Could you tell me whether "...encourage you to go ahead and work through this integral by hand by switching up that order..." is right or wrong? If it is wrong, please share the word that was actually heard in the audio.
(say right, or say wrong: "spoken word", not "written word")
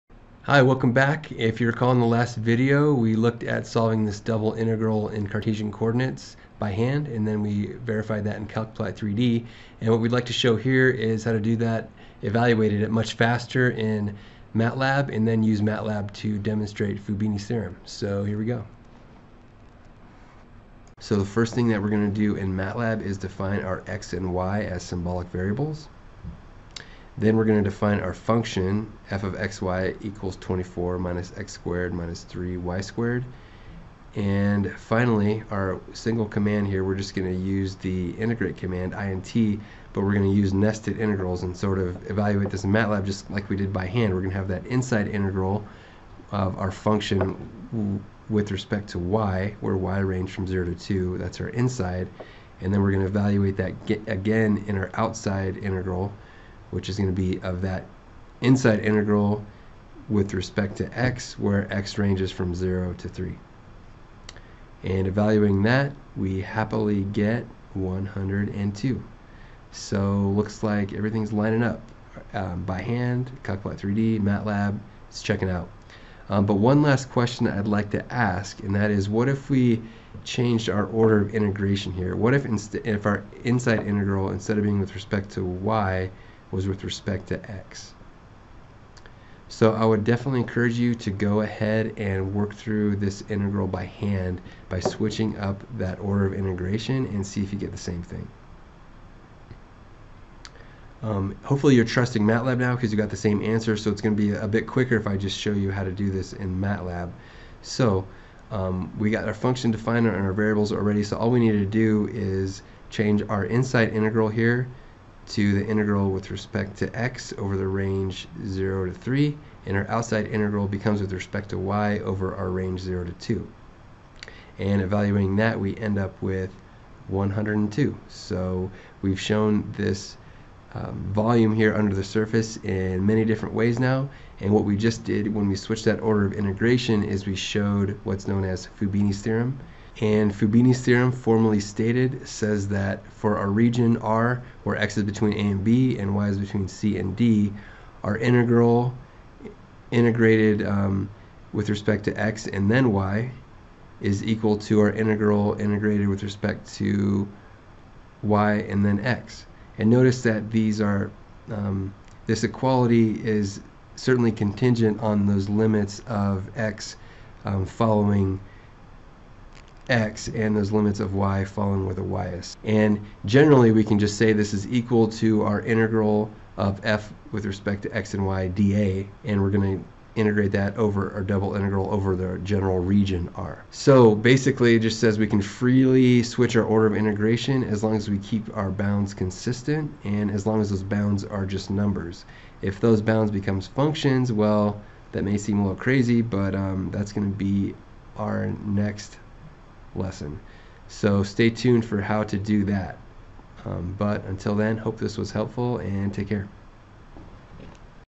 right.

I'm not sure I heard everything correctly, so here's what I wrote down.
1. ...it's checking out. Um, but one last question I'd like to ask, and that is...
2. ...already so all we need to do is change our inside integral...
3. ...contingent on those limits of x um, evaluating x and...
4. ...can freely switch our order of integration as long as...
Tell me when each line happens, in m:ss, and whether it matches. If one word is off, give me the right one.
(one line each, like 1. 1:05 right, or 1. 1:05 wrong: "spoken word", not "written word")
1. 1:15 right
2. 1:50 right
3. 2:44 wrong: "following", not "evaluating"
4. 3:05 right.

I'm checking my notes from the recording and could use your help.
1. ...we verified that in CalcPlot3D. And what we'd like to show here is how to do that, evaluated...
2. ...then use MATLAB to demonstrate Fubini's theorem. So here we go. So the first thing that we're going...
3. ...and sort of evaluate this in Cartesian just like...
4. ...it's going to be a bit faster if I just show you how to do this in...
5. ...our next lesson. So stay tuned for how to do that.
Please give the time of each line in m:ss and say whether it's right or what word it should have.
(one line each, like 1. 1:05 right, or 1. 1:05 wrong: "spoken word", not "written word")
1. 0:07 right
2. 0:15 right
3. 0:41 wrong: "MATLAB", not "Cartesian"
4. 1:43 wrong: "quicker", not "faster"
5. 3:18 right.